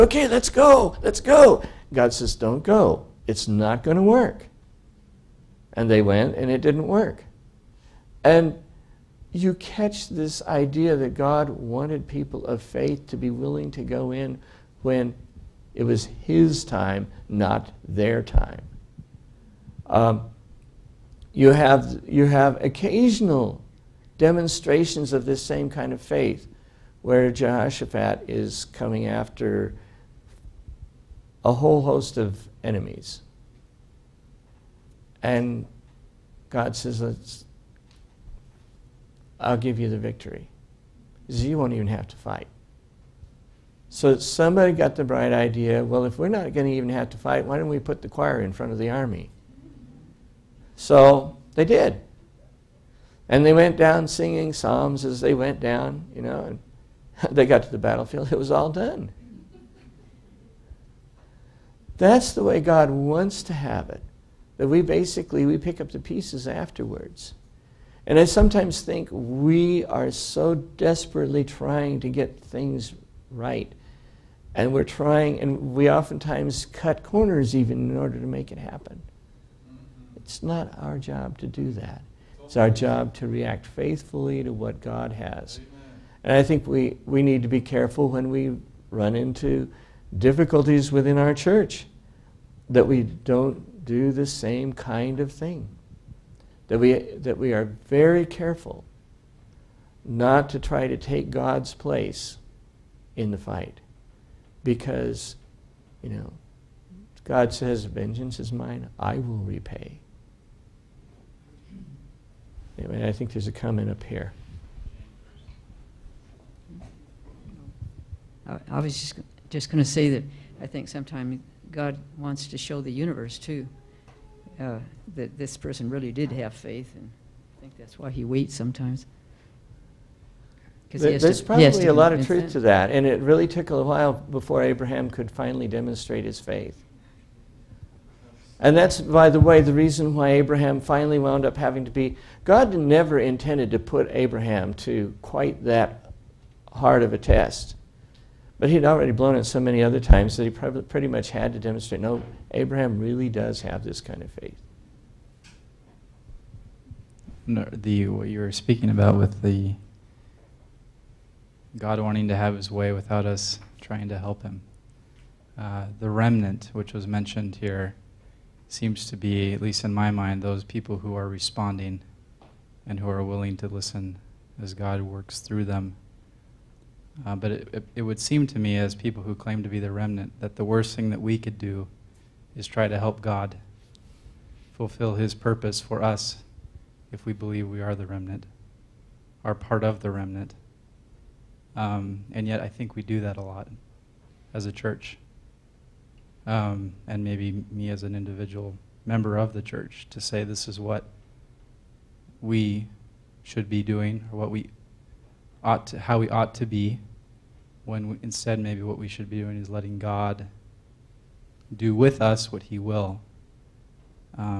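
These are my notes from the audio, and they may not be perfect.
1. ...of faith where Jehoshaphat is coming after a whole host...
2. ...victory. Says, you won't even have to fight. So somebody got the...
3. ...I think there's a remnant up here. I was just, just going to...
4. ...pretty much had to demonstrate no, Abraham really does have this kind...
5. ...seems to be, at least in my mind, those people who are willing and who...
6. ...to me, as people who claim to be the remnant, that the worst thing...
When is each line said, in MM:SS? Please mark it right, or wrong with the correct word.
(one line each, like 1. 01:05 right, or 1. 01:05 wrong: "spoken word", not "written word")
1. 00:25 right
2. 00:39 right
3. 01:53 wrong: "comment", not "remnant"
4. 02:30 right
5. 02:48 wrong: "responding", not "willing"
6. 02:58 right.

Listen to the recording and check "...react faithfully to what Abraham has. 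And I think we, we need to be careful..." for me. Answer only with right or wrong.
wrong.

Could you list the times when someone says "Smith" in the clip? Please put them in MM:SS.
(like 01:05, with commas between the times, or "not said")
not said.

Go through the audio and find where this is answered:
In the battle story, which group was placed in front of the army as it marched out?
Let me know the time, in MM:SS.
00:48.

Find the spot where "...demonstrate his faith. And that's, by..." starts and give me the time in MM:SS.
02:15.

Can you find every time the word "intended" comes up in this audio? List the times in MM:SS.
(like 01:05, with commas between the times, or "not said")
02:23.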